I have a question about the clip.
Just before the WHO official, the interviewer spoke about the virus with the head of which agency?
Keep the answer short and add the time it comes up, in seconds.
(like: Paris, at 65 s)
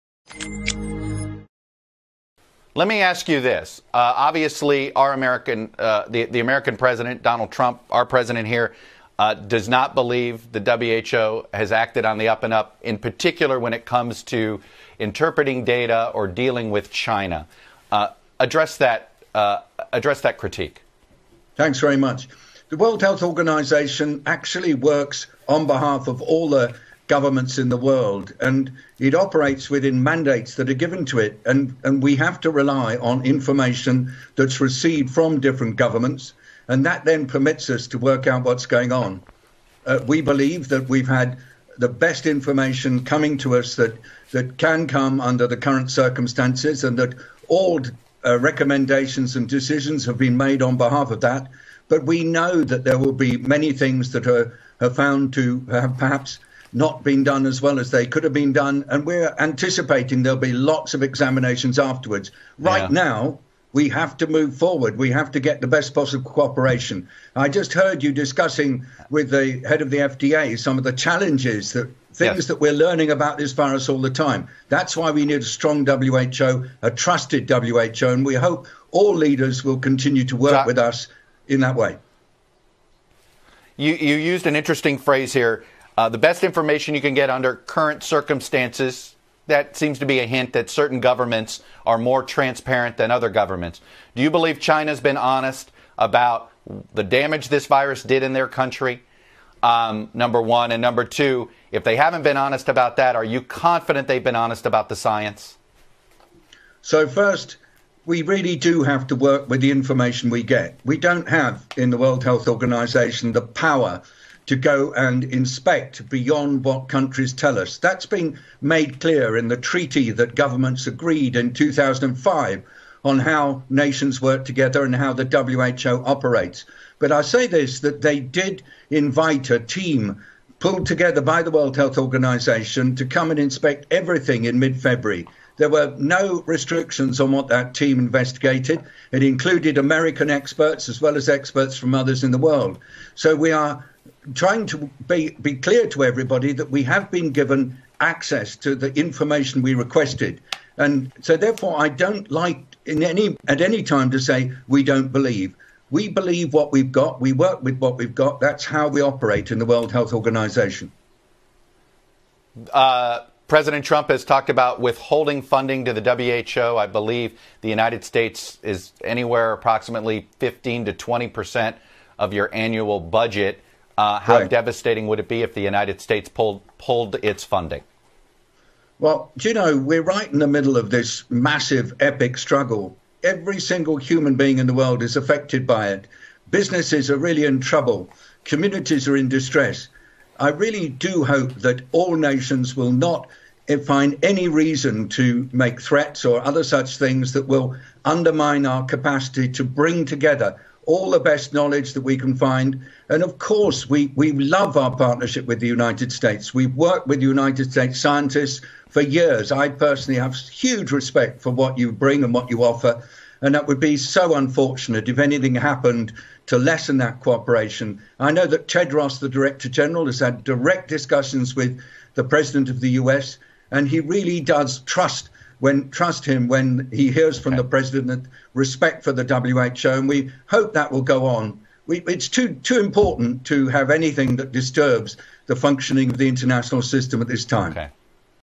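FDA, at 69 s.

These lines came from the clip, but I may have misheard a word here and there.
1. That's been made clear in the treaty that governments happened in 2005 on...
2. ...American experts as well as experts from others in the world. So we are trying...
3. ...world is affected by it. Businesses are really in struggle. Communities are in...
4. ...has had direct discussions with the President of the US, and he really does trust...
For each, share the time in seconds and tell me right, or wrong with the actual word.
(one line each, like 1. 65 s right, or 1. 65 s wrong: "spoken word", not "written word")
1. 117 s wrong: "agreed", not "happened"
2. 139 s right
3. 184 s wrong: "trouble", not "struggle"
4. 220 s right.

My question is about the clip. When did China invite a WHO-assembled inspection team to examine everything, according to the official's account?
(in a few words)
mid February.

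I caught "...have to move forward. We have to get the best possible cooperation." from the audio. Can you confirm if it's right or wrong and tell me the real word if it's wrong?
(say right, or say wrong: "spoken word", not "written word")
right.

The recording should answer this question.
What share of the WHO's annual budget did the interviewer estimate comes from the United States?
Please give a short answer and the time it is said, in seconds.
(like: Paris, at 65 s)
15 to 20 percent, at 170 s.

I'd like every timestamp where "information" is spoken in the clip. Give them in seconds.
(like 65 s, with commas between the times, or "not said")
33 s, 42 s, 86 s, 109 s, 148 s.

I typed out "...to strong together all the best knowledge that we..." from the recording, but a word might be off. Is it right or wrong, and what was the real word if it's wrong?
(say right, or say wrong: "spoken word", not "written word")
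wrong: "bring", not "strong".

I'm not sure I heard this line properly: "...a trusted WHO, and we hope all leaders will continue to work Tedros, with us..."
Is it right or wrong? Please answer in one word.
wrong.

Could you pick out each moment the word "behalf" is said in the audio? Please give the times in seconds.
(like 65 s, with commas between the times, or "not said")
25 s, 50 s.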